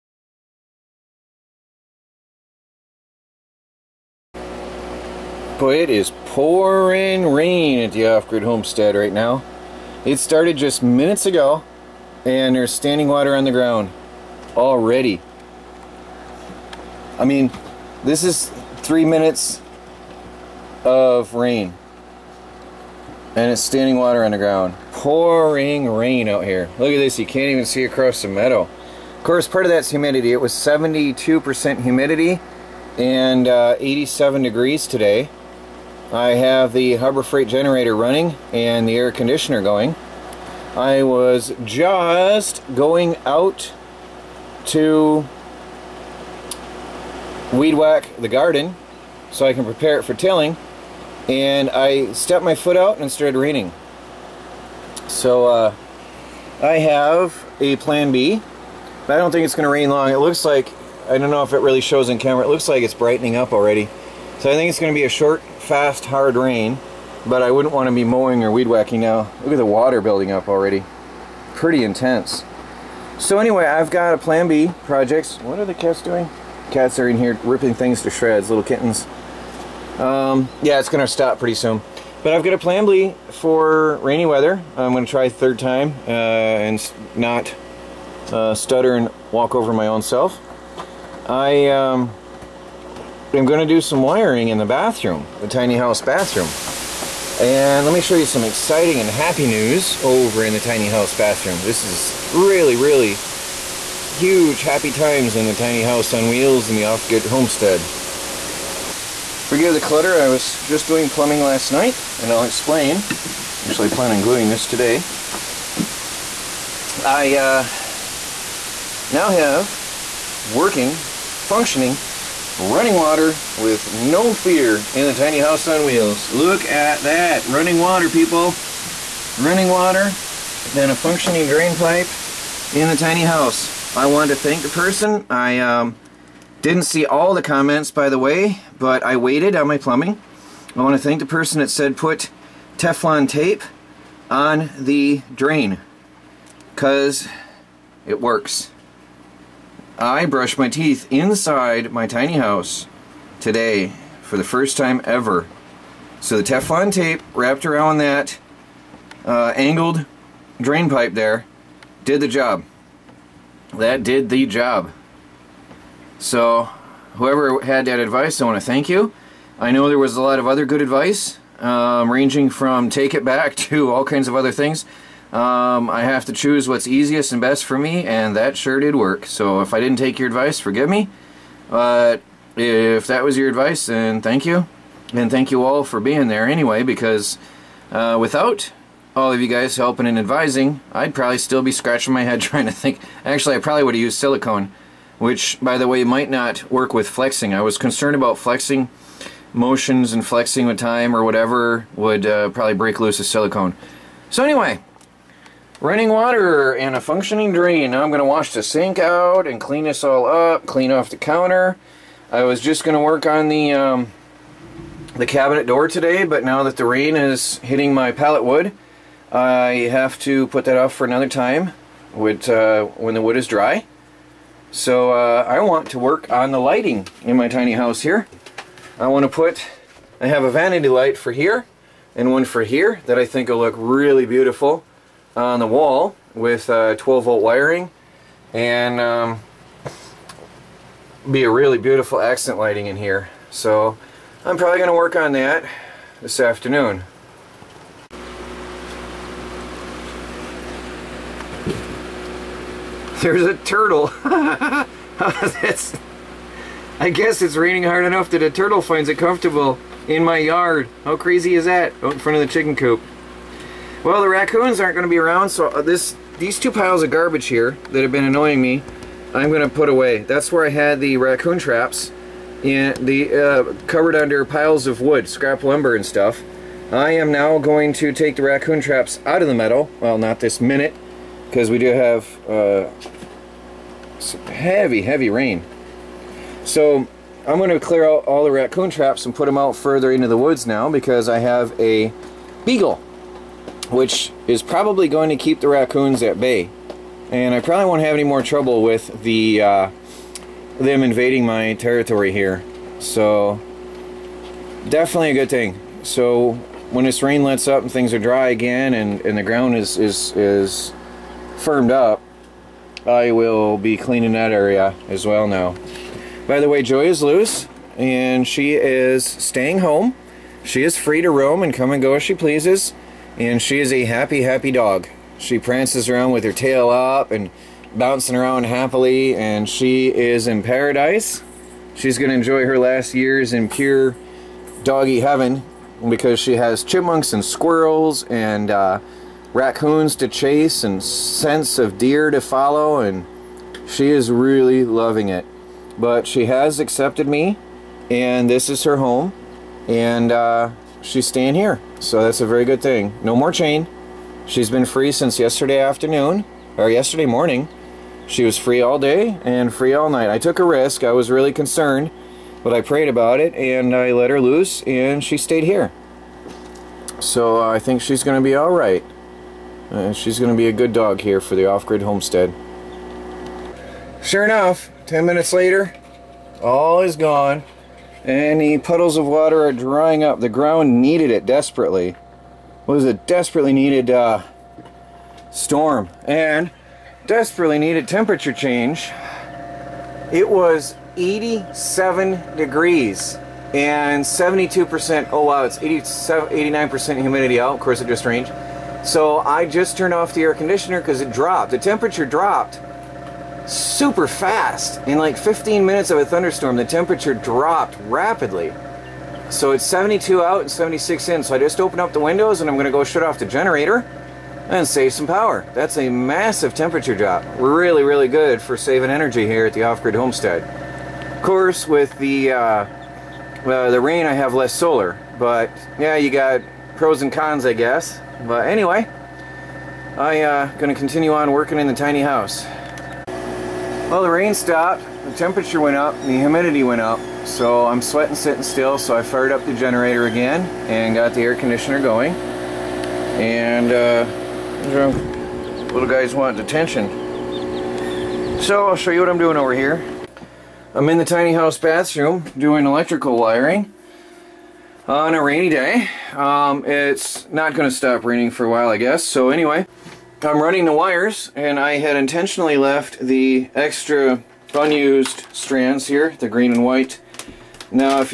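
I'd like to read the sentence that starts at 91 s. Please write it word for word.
I um, I'm going to do some wiring in the bathroom, the tiny house bathroom.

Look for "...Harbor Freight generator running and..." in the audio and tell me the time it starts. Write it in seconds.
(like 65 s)
36 s.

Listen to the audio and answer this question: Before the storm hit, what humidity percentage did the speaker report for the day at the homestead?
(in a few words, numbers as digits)
72%.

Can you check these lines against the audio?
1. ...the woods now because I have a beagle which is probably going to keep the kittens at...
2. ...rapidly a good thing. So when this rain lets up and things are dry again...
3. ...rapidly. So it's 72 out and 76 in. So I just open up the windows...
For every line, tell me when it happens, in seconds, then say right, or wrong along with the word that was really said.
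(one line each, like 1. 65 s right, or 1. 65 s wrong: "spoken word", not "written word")
1. 290 s wrong: "raccoons", not "kittens"
2. 304 s wrong: "definitely", not "rapidly"
3. 408 s right.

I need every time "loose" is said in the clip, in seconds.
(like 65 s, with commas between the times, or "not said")
202 s, 317 s, 364 s.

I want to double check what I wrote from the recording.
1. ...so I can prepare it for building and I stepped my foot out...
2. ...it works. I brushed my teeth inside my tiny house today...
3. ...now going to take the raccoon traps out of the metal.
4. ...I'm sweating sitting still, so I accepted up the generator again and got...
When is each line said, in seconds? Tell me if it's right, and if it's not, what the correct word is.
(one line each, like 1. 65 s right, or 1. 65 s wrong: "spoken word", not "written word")
1. 49 s wrong: "tilling", not "building"
2. 148 s right
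3. 277 s right
4. 437 s wrong: "fired", not "accepted".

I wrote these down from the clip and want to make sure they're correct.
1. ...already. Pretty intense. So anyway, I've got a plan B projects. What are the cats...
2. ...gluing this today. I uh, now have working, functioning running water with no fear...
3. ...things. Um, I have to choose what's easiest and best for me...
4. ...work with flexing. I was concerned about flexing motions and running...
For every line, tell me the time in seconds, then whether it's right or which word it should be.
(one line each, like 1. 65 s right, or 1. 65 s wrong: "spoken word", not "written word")
1. 70 s right
2. 114 s right
3. 174 s right
4. 196 s wrong: "flexing", not "running".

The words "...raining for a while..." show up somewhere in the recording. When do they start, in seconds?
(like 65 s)
458 s.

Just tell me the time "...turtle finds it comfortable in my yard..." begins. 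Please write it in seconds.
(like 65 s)
258 s.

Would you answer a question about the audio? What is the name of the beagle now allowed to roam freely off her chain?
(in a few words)
Joy.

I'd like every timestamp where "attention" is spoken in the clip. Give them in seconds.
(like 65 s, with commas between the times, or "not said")
446 s.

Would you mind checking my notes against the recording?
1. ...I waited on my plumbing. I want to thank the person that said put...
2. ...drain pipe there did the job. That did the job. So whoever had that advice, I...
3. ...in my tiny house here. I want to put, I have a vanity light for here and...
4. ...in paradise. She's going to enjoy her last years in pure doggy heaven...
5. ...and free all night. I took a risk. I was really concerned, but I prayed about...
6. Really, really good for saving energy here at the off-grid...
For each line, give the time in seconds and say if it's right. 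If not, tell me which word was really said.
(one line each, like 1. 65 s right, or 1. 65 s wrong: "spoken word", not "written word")
1. 139 s right
2. 160 s right
3. 227 s right
4. 330 s right
5. 359 s right
6. 417 s right.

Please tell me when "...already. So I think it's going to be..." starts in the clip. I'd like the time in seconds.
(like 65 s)
63 s.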